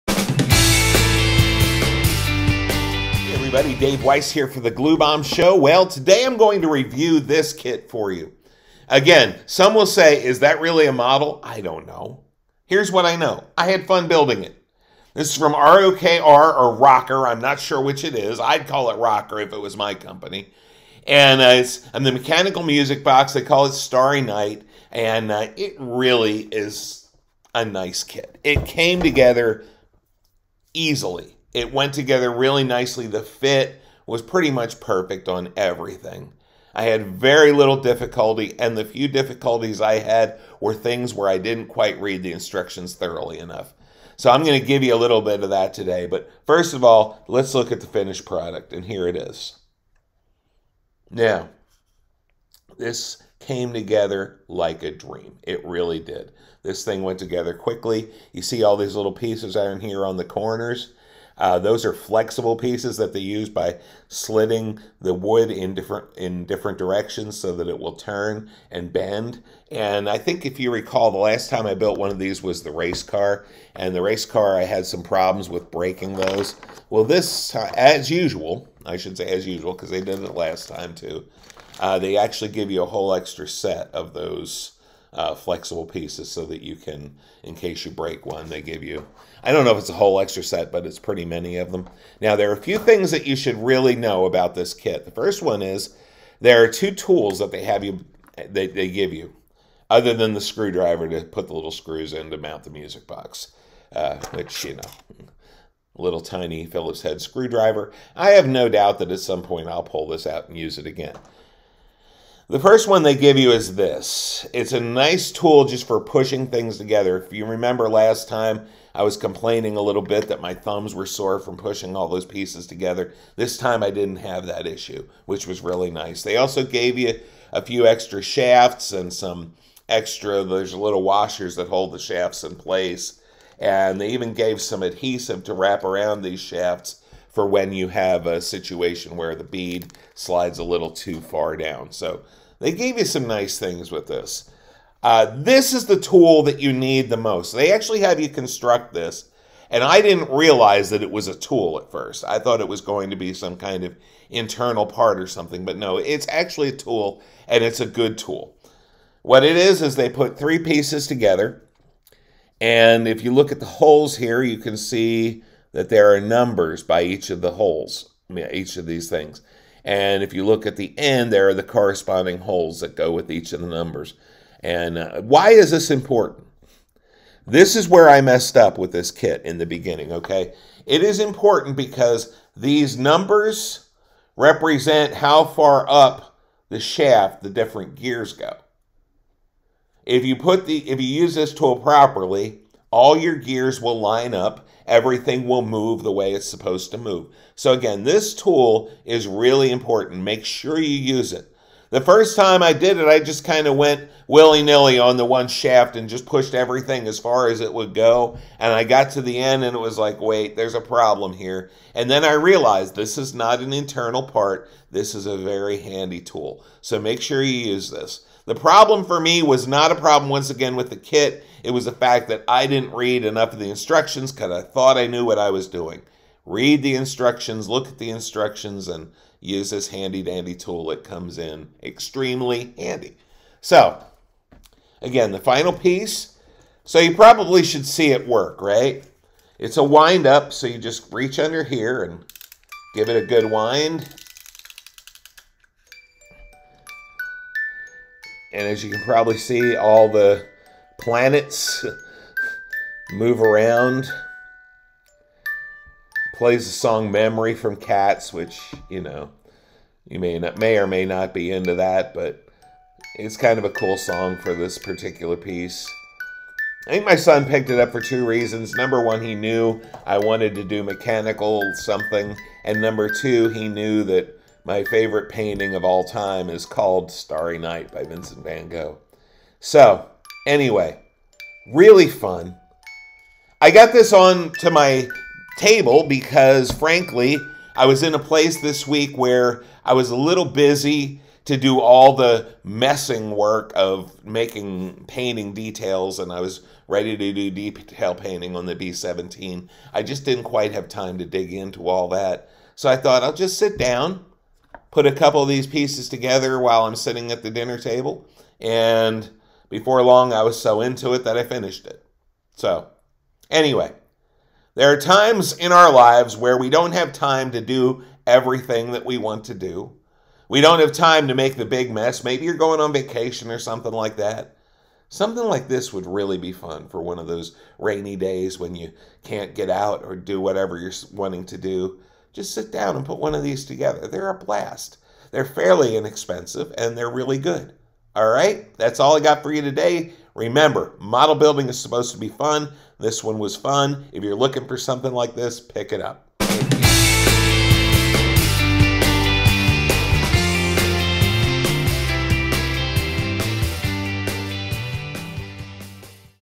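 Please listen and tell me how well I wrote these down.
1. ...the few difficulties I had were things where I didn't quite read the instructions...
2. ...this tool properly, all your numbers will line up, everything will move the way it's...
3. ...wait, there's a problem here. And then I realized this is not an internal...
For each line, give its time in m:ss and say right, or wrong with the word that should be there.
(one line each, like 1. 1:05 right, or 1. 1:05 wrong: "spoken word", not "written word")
1. 0:38 right
2. 3:11 wrong: "gears", not "numbers"
3. 3:30 right.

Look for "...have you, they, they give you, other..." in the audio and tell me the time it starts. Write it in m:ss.
1:37.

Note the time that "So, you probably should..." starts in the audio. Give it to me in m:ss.
3:56.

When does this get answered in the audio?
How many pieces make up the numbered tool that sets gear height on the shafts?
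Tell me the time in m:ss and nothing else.
2:40.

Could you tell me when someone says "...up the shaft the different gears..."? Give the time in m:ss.
3:05.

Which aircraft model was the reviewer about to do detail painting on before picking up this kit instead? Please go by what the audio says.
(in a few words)
B17.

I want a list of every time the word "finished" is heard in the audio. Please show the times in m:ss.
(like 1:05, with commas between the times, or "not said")
0:47, 5:11.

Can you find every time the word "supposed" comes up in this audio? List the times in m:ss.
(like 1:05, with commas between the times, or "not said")
3:16, 5:41.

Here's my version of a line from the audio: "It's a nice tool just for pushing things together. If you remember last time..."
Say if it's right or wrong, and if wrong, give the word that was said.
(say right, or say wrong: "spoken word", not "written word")
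right.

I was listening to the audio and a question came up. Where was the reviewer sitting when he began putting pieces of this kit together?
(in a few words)
dinner table.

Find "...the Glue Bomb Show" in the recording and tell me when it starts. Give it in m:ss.
0:04.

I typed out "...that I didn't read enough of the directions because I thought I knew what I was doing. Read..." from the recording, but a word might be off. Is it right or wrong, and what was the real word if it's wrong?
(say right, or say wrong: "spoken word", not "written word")
wrong: "instructions", not "directions".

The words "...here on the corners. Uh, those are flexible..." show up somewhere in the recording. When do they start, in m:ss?
0:59.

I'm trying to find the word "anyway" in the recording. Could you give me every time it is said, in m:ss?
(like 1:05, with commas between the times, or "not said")
4:40, 5:13.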